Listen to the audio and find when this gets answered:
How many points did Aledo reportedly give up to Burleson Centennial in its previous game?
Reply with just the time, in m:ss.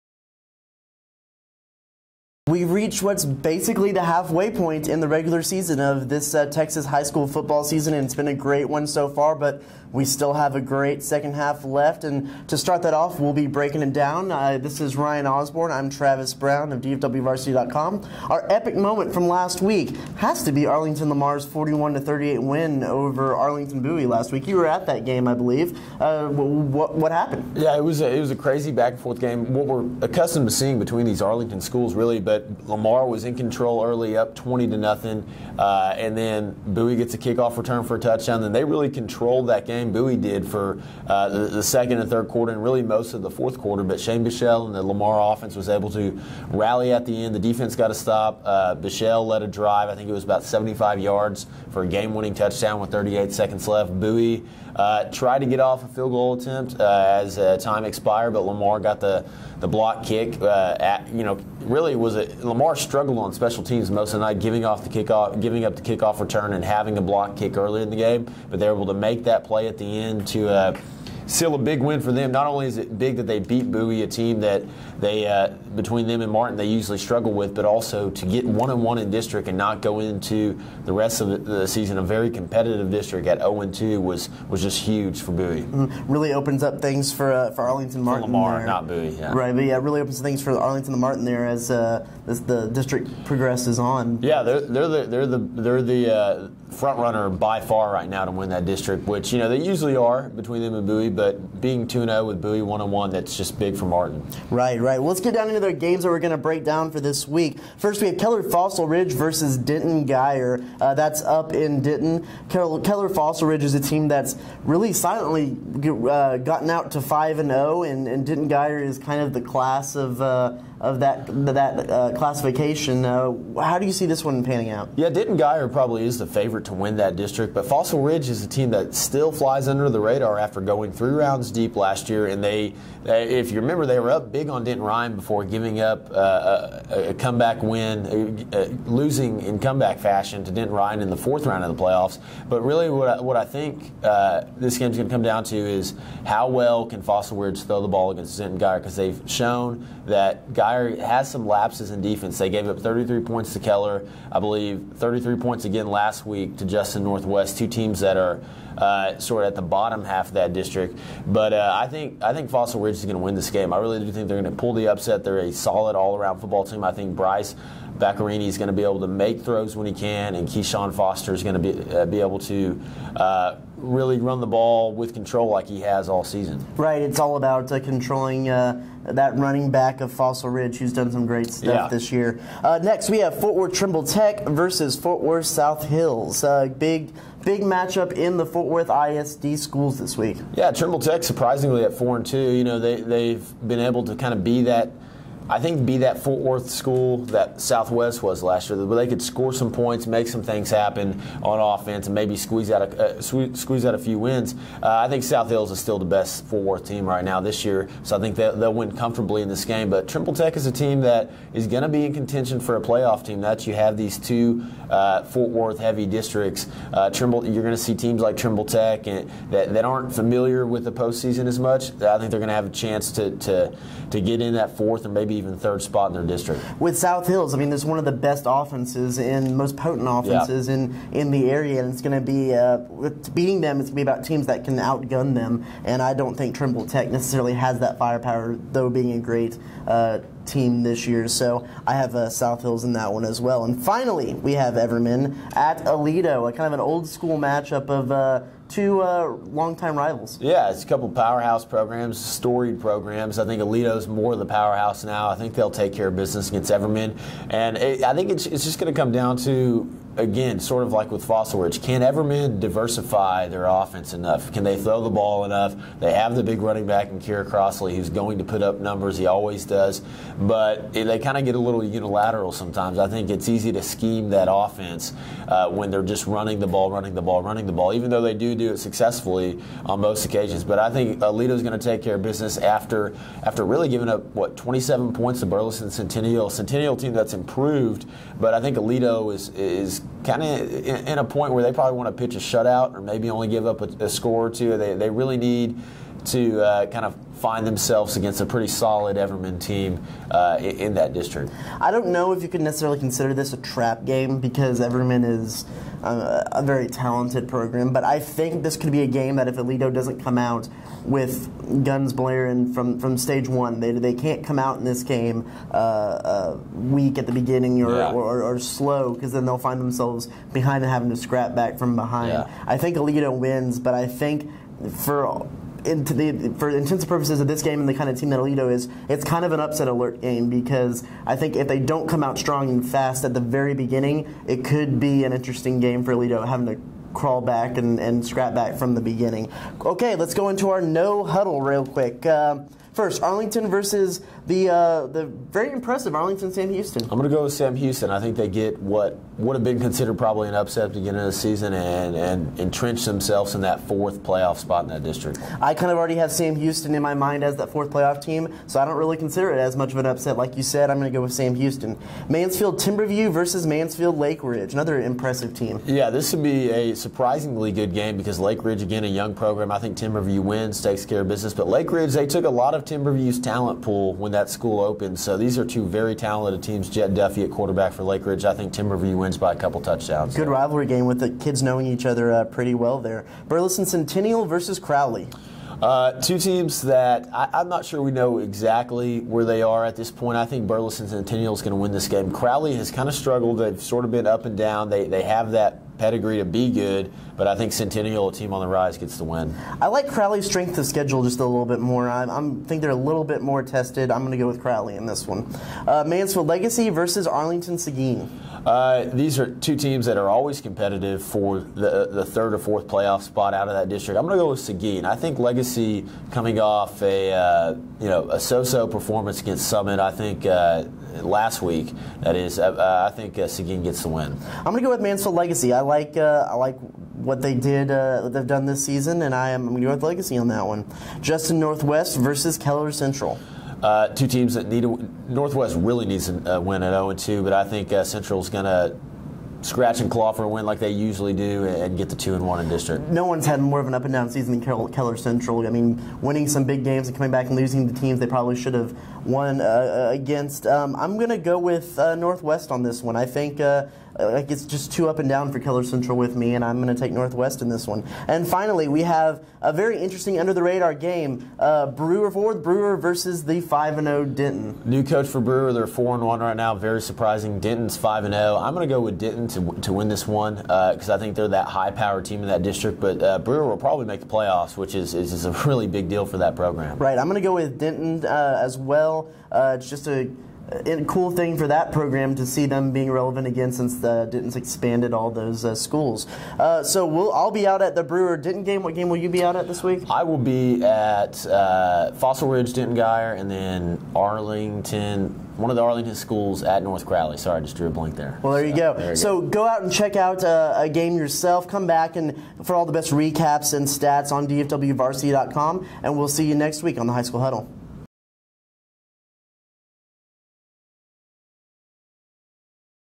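4:44.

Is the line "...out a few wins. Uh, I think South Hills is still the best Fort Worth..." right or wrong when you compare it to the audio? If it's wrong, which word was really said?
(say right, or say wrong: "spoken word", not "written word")
right.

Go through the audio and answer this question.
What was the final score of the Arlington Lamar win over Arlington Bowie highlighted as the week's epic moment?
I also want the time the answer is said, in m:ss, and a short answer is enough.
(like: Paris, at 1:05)
41 to 38, at 0:21.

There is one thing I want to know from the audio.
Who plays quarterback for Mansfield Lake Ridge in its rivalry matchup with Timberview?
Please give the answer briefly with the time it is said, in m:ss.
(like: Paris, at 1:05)
Jett Duffey, at 6:16.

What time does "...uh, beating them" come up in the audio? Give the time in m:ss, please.
3:52.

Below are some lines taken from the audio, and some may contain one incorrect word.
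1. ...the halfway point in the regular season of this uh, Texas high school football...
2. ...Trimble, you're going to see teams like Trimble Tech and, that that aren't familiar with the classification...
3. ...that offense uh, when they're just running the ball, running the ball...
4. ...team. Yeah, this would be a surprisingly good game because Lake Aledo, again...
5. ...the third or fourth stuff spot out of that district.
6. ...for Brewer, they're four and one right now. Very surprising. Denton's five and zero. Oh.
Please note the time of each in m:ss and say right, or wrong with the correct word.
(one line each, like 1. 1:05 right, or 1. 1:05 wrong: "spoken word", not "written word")
1. 0:03 right
2. 3:37 wrong: "postseason", not "classification"
3. 4:34 right
4. 6:05 wrong: "Ridge", not "Aledo"
5. 6:52 wrong: "playoff", not "stuff"
6. 7:45 right.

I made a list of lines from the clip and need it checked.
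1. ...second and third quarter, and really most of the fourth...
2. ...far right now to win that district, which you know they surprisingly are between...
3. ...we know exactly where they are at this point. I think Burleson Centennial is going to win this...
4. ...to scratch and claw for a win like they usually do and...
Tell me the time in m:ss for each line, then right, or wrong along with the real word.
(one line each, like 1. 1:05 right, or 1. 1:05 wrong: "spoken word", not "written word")
1. 0:41 right
2. 1:37 wrong: "usually", not "surprisingly"
3. 6:28 right
4. 7:18 right.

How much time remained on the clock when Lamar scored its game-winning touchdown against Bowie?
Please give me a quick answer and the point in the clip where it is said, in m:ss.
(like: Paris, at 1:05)
38 seconds, at 0:52.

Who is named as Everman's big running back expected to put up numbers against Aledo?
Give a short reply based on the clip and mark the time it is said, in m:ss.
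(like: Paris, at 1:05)
Kira Crossley, at 4:27.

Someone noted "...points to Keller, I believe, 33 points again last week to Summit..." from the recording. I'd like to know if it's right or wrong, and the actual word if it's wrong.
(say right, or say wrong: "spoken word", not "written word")
wrong: "Justin", not "Summit".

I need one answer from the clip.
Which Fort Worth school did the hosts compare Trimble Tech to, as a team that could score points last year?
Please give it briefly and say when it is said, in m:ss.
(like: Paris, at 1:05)
Southwest, at 3:17.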